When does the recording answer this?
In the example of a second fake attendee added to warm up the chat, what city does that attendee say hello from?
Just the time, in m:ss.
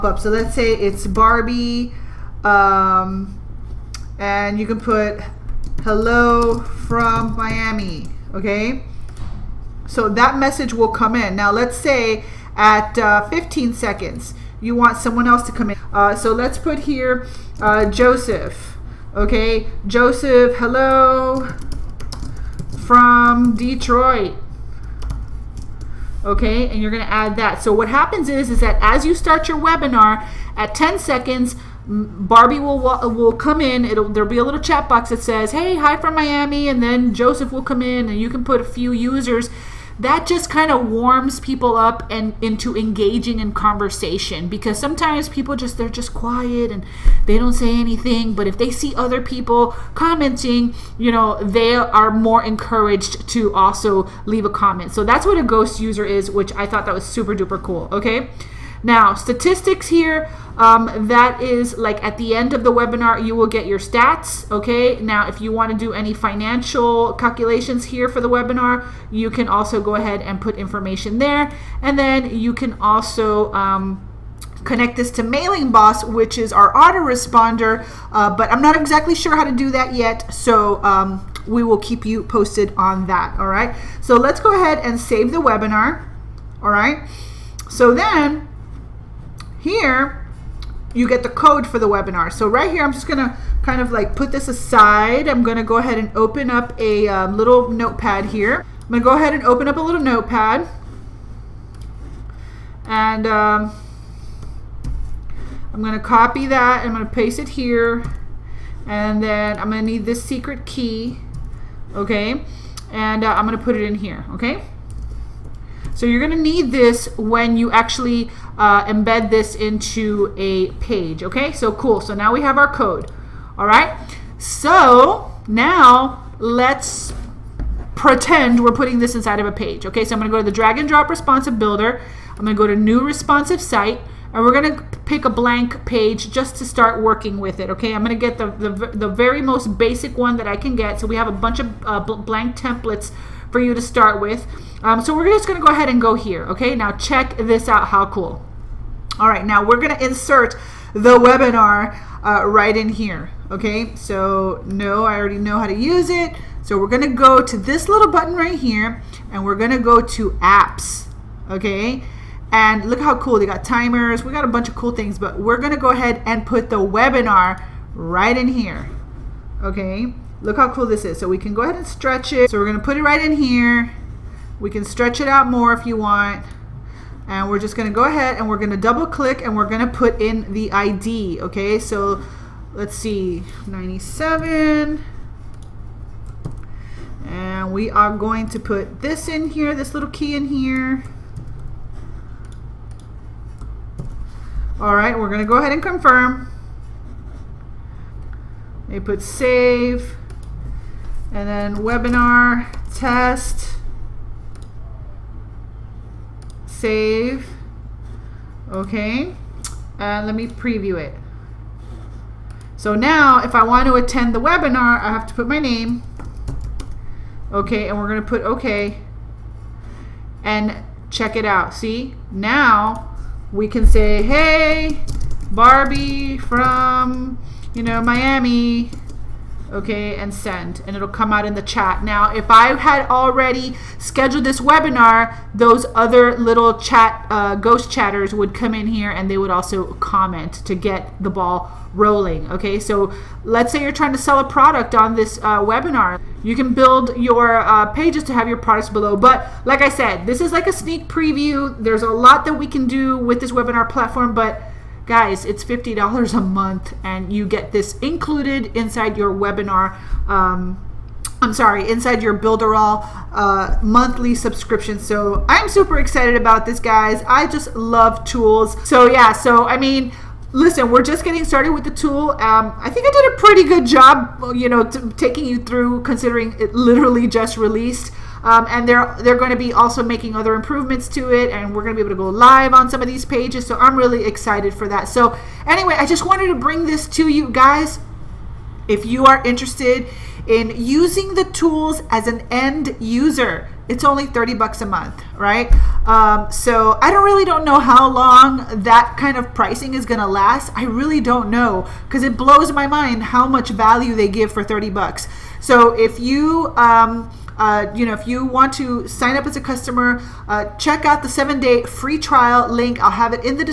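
0:23.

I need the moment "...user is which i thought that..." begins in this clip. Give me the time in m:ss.
0:55.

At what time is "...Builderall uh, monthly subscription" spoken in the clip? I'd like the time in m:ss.
4:22.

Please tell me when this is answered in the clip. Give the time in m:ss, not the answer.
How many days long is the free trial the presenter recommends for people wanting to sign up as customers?
5:11.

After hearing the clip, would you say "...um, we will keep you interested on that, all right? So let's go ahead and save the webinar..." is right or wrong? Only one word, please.
wrong.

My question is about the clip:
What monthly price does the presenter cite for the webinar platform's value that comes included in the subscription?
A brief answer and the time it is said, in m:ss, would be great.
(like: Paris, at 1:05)
$50, at 4:15.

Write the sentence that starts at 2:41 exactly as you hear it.
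Okay, and look how cool they got timers.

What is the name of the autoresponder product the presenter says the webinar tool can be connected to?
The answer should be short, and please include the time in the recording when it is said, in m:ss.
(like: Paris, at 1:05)
Mailing Boss, at 1:15.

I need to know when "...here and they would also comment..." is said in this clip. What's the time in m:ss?
3:58.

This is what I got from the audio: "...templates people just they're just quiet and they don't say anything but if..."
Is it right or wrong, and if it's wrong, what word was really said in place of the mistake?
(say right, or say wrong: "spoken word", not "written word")
wrong: "sometimes", not "templates".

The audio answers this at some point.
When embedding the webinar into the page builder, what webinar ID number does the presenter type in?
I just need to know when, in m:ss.
3:03.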